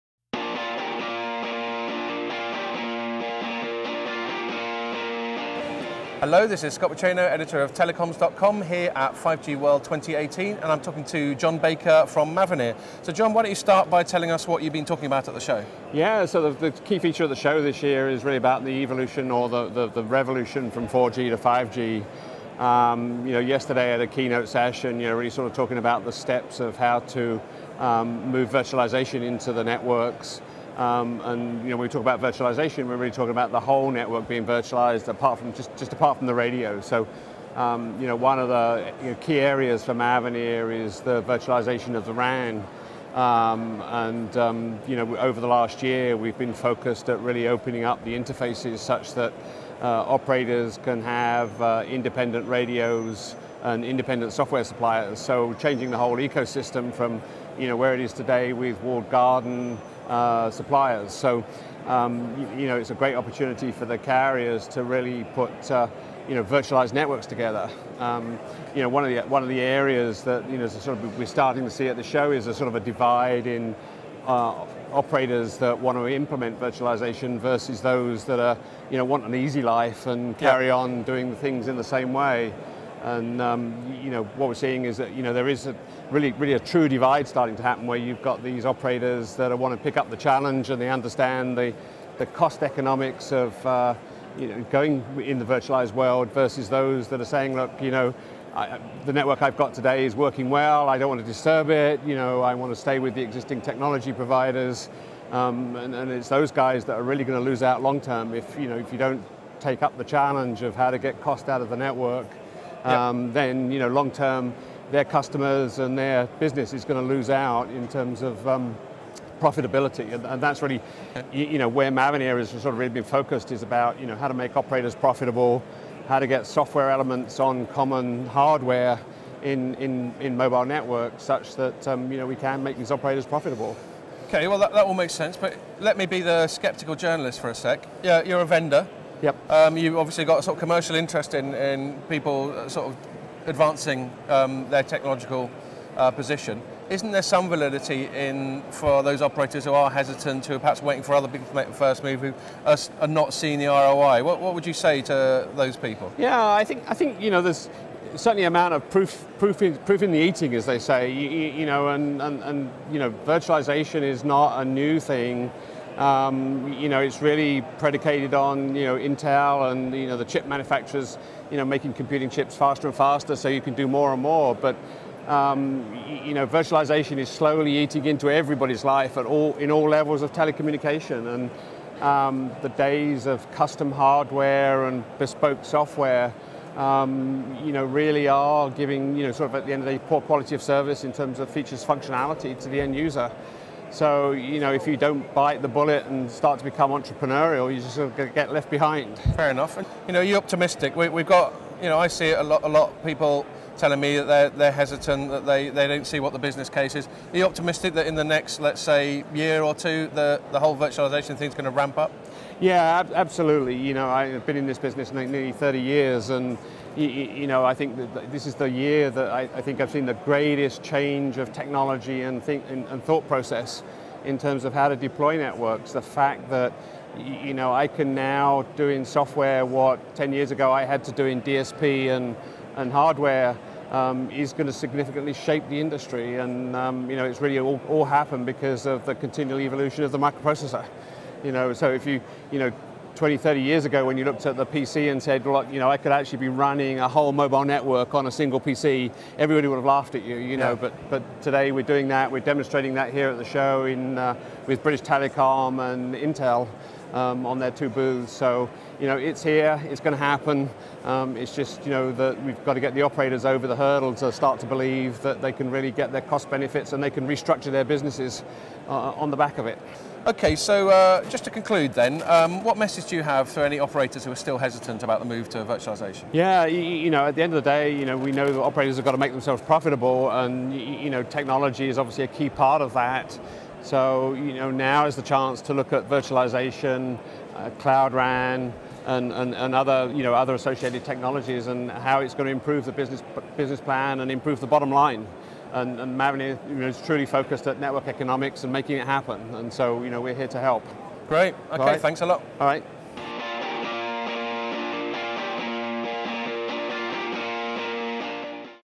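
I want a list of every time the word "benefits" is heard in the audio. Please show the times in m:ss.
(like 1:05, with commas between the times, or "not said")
4:26.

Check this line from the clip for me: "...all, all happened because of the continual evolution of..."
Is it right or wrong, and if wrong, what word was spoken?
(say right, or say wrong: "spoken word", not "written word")
right.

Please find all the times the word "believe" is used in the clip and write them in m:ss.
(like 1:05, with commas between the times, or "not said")
4:24.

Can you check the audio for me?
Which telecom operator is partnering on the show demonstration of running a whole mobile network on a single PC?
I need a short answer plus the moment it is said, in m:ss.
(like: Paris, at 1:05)
British Telecom, at 4:14.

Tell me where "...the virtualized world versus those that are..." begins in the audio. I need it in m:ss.
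1:35.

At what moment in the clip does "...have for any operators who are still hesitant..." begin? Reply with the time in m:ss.
4:33.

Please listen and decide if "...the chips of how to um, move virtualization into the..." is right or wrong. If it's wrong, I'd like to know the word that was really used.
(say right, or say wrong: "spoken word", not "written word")
wrong: "steps", not "chips".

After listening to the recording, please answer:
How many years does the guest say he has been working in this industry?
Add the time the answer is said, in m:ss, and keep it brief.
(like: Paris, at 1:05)
Nearly 30 years, at 3:35.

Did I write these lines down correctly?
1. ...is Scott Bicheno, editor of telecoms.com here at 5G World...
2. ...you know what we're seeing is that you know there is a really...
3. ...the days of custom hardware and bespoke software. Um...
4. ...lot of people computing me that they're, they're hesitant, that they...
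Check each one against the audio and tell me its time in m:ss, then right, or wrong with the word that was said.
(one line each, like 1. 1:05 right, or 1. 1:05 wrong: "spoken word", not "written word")
1. 0:06 right
2. 1:24 right
3. 3:02 right
4. 3:22 wrong: "telling", not "computing".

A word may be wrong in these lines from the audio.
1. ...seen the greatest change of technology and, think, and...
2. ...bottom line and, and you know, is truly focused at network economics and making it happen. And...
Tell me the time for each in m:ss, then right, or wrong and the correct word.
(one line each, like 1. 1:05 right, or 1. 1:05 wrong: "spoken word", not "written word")
1. 3:39 right
2. 4:54 right.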